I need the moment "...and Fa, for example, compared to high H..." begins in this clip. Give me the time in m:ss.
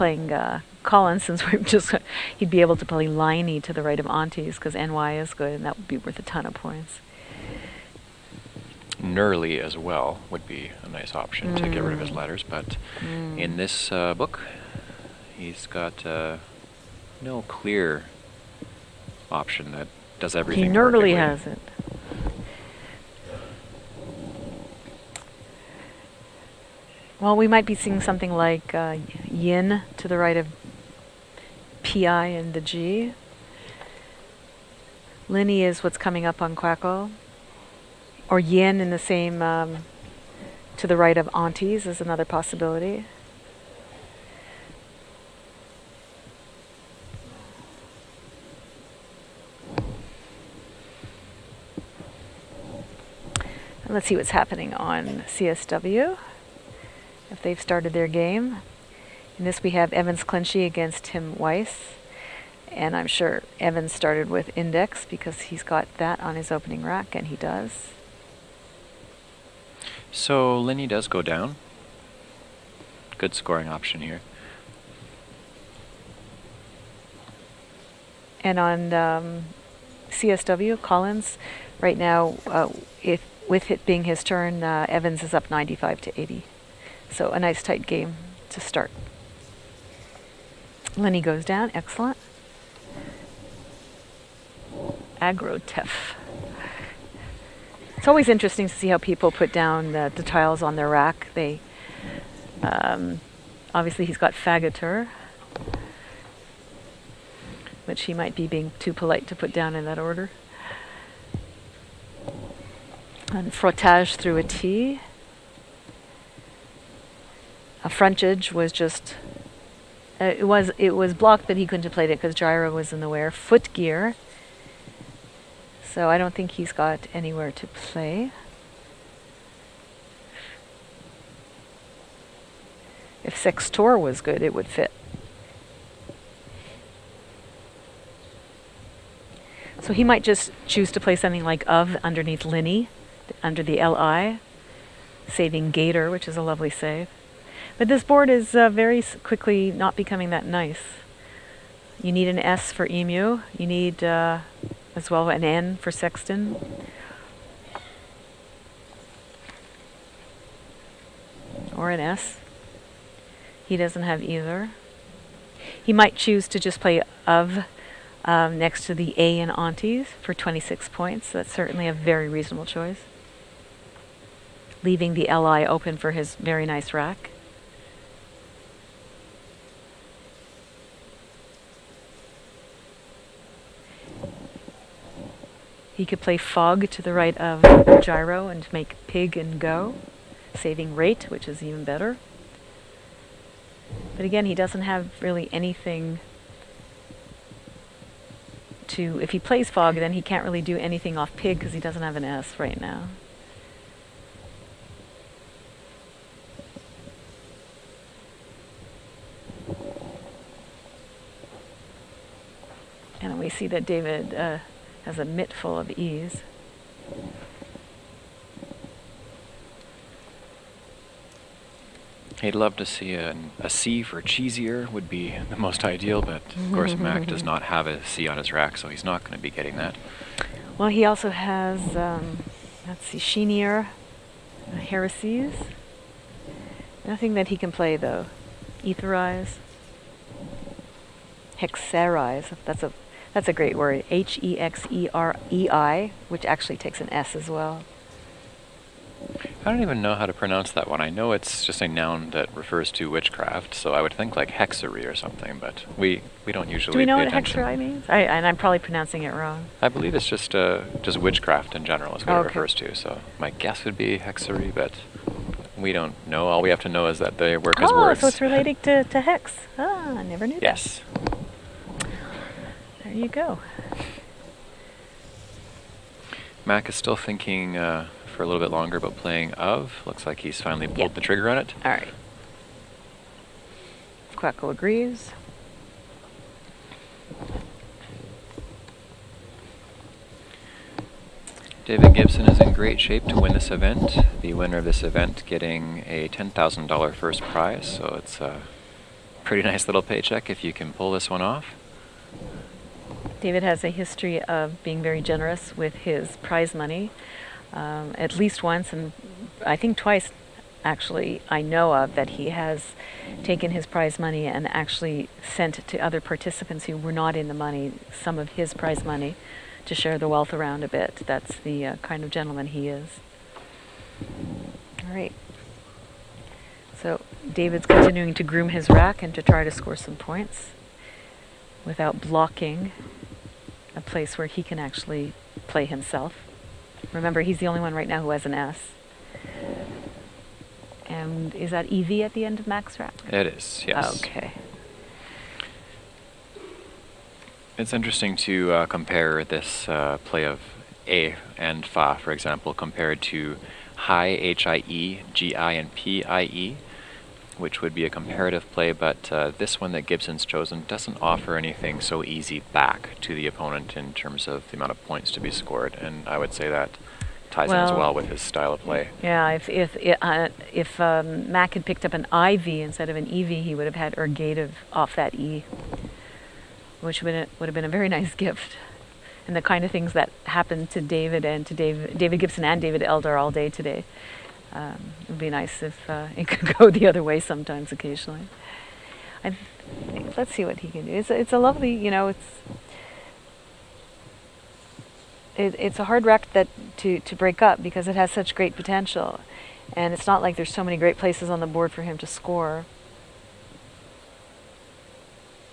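5:51.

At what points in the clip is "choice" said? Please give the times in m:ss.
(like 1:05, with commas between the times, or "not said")
2:52.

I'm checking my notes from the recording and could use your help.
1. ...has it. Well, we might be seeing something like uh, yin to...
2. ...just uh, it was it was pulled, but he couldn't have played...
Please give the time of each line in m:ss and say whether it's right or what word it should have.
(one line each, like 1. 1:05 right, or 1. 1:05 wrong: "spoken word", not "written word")
1. 0:21 right
2. 1:58 wrong: "blocked", not "pulled".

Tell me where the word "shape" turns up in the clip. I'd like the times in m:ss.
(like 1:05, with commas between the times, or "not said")
4:52.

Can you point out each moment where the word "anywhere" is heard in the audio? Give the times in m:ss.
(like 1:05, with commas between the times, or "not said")
2:07.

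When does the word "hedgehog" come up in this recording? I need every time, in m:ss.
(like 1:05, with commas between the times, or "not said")
not said.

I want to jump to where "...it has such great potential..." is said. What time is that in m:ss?
6:38.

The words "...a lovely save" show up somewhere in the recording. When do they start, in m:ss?
2:26.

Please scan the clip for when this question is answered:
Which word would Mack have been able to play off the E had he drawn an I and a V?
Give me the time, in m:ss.
6:14.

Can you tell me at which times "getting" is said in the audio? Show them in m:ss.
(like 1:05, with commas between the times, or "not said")
3:49, 4:55.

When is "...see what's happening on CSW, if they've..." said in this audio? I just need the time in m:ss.
0:54.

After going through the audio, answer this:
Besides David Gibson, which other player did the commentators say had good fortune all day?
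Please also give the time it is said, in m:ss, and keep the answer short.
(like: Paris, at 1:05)
David Elder, at 6:22.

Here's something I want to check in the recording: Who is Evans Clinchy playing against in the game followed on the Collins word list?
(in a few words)
Tim Weiss.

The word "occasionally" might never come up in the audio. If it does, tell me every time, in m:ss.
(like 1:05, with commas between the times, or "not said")
6:27.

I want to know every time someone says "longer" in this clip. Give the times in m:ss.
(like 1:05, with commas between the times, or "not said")
4:38.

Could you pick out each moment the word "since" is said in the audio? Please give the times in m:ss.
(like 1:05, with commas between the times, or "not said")
0:01.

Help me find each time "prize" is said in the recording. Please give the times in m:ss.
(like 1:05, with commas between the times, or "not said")
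4:57, 5:06, 5:13, 5:18.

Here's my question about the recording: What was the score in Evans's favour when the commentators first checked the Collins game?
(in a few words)
95 to 80.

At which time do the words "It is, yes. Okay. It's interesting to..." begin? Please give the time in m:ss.
5:43.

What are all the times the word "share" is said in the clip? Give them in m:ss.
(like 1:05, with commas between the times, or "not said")
5:19.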